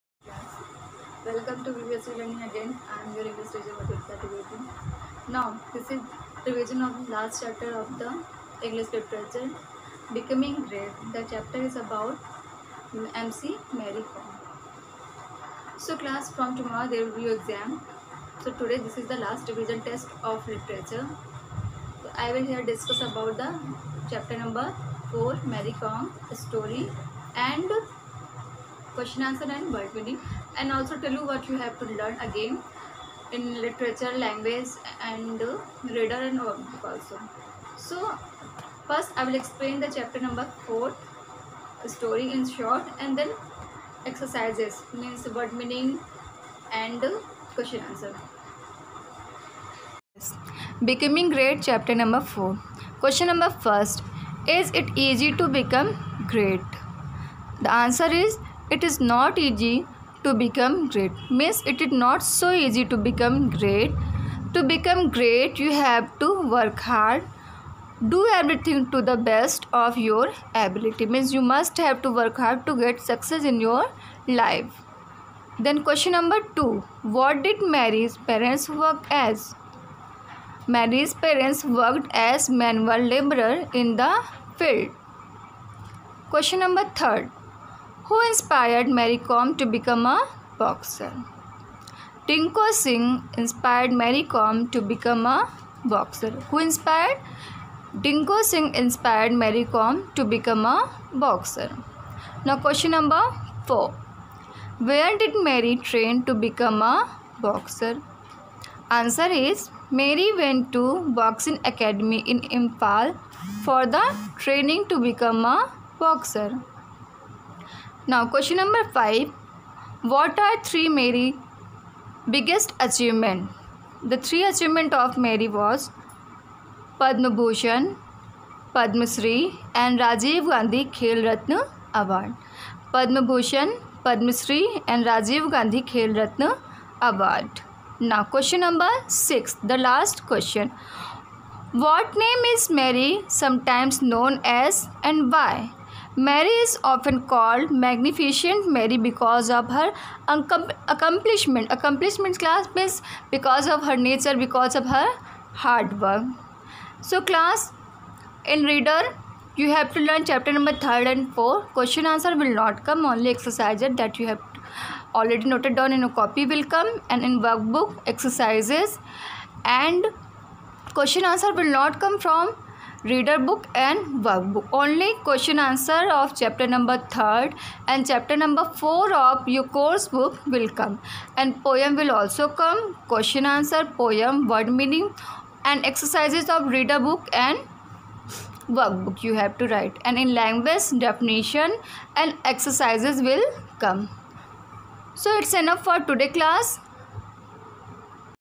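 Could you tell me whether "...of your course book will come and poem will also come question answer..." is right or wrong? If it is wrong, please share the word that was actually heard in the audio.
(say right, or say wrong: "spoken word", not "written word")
right.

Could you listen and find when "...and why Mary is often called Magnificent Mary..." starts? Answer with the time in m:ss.
2:25.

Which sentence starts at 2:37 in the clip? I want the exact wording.
So class, in reader, you have to learn chapter number 3 and 4.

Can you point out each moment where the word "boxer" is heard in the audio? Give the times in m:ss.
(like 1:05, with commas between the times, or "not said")
1:30, 1:35, 1:41, 1:47, 1:55.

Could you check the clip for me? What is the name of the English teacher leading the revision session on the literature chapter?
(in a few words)
Madhurika Trivedi.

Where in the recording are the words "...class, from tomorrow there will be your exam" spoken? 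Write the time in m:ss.
0:15.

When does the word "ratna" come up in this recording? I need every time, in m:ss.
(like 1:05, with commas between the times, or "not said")
2:11, 2:16.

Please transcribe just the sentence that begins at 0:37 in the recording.
So first I will explain the chapter number 4 story in short and then exercises means word meaning and uh, question answer.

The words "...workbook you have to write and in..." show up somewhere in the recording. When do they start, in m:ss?
3:08.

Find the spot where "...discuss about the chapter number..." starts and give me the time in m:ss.
0:22.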